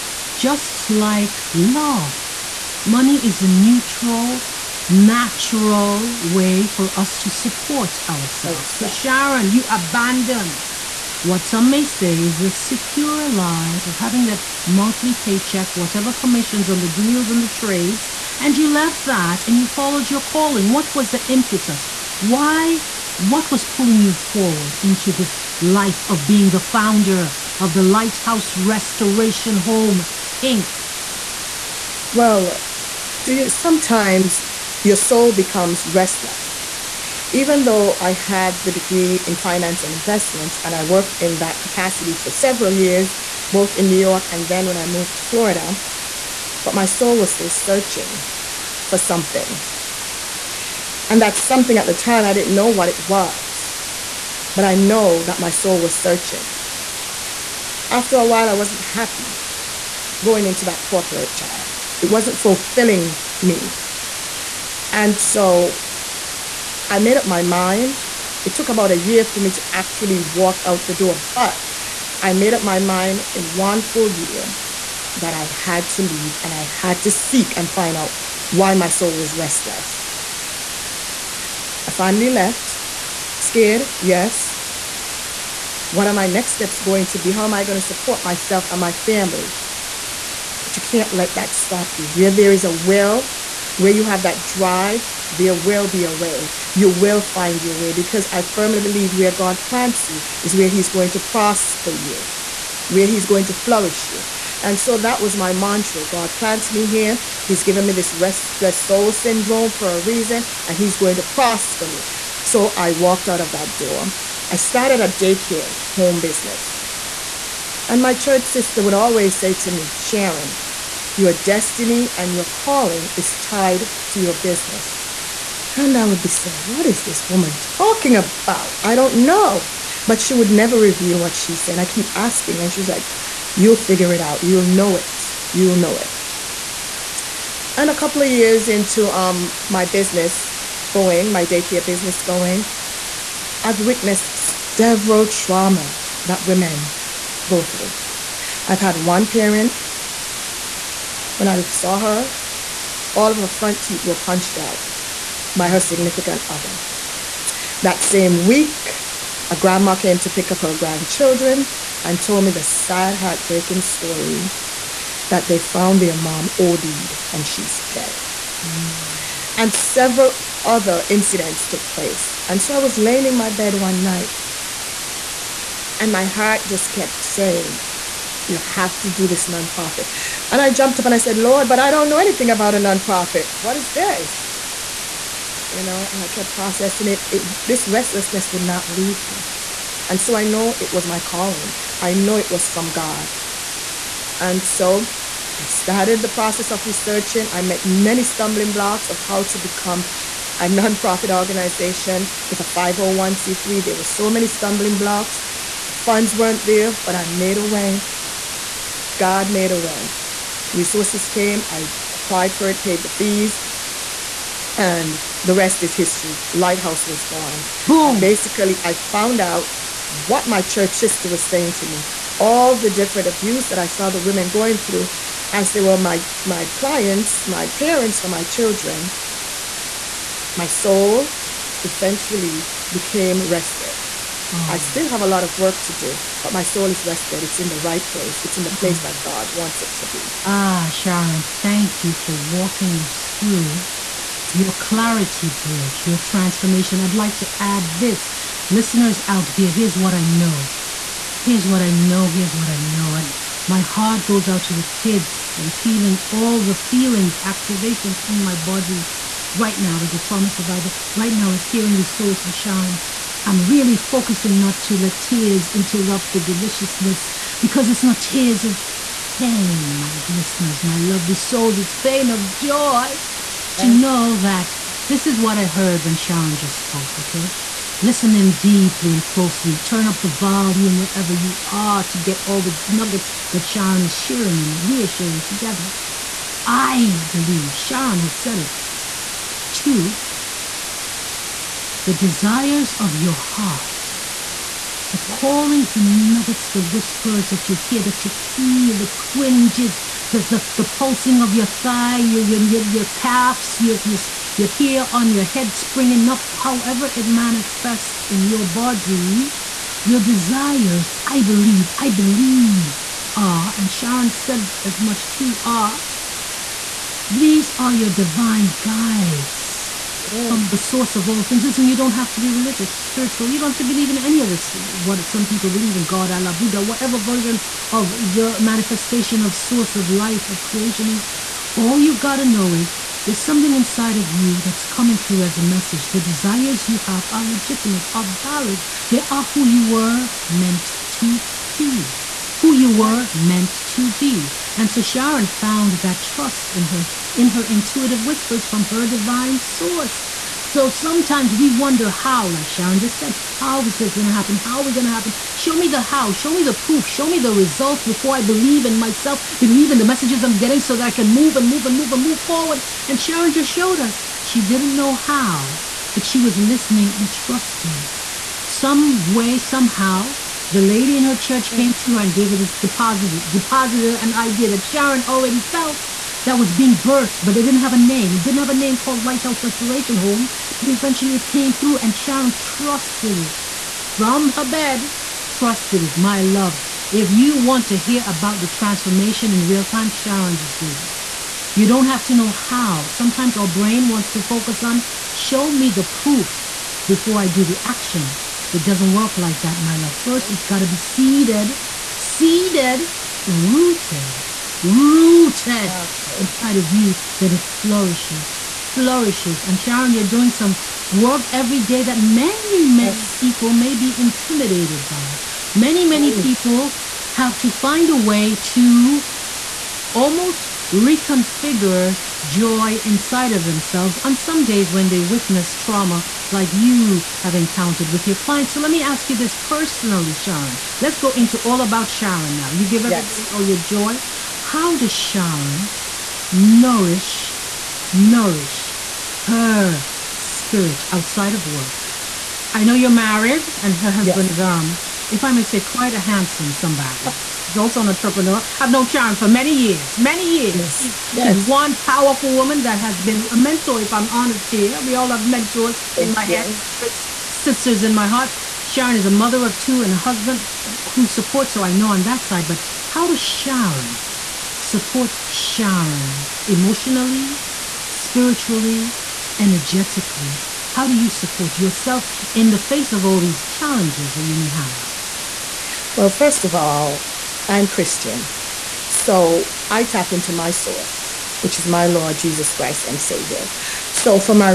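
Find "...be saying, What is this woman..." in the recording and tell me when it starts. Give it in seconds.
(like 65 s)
126 s.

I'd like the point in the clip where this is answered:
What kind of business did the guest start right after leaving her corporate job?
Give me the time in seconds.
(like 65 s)
115 s.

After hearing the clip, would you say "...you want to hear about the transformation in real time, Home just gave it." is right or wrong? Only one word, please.
wrong.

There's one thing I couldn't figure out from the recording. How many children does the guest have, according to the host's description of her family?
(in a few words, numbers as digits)
2.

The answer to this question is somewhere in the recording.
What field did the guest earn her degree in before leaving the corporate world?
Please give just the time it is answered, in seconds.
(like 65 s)
39 s.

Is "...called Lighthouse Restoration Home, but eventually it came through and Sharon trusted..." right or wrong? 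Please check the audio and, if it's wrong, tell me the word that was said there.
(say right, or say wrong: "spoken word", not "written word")
right.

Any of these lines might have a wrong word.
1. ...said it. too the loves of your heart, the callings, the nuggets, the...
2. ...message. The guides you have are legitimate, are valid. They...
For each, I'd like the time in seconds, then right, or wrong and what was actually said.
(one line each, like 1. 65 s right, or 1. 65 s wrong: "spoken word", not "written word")
1. 288 s wrong: "desires", not "loves"
2. 335 s wrong: "desires", not "guides".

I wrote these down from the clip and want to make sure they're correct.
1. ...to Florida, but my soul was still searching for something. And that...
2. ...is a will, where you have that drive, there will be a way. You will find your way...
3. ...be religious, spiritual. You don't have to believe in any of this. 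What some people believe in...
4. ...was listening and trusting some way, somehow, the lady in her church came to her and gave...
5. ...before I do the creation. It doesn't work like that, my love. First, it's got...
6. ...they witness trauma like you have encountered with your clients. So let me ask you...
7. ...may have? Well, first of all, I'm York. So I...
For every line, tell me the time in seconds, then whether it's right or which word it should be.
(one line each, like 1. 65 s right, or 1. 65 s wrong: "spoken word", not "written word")
1. 45 s right
2. 92 s right
3. 322 s right
4. 366 s right
5. 397 s wrong: "action", not "creation"
6. 425 s right
7. 474 s wrong: "Christian", not "York".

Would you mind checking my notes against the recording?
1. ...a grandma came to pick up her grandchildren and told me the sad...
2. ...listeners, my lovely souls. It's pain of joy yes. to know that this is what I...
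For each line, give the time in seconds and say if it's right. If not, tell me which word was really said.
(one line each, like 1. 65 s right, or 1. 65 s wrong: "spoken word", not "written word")
1. 159 s right
2. 270 s right.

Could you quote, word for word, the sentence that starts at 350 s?
So sometimes we wonder how, like Sharon just said, how is this going to happen?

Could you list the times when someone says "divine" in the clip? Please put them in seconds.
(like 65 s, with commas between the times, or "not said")
318 s, 349 s.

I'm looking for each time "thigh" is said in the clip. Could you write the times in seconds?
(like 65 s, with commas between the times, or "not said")
301 s.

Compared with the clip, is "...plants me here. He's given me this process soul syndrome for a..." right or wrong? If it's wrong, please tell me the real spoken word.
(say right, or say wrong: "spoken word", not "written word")
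wrong: "restless", not "process".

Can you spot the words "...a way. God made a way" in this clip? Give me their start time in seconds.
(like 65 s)
207 s.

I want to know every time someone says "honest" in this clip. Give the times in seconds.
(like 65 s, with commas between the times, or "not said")
454 s.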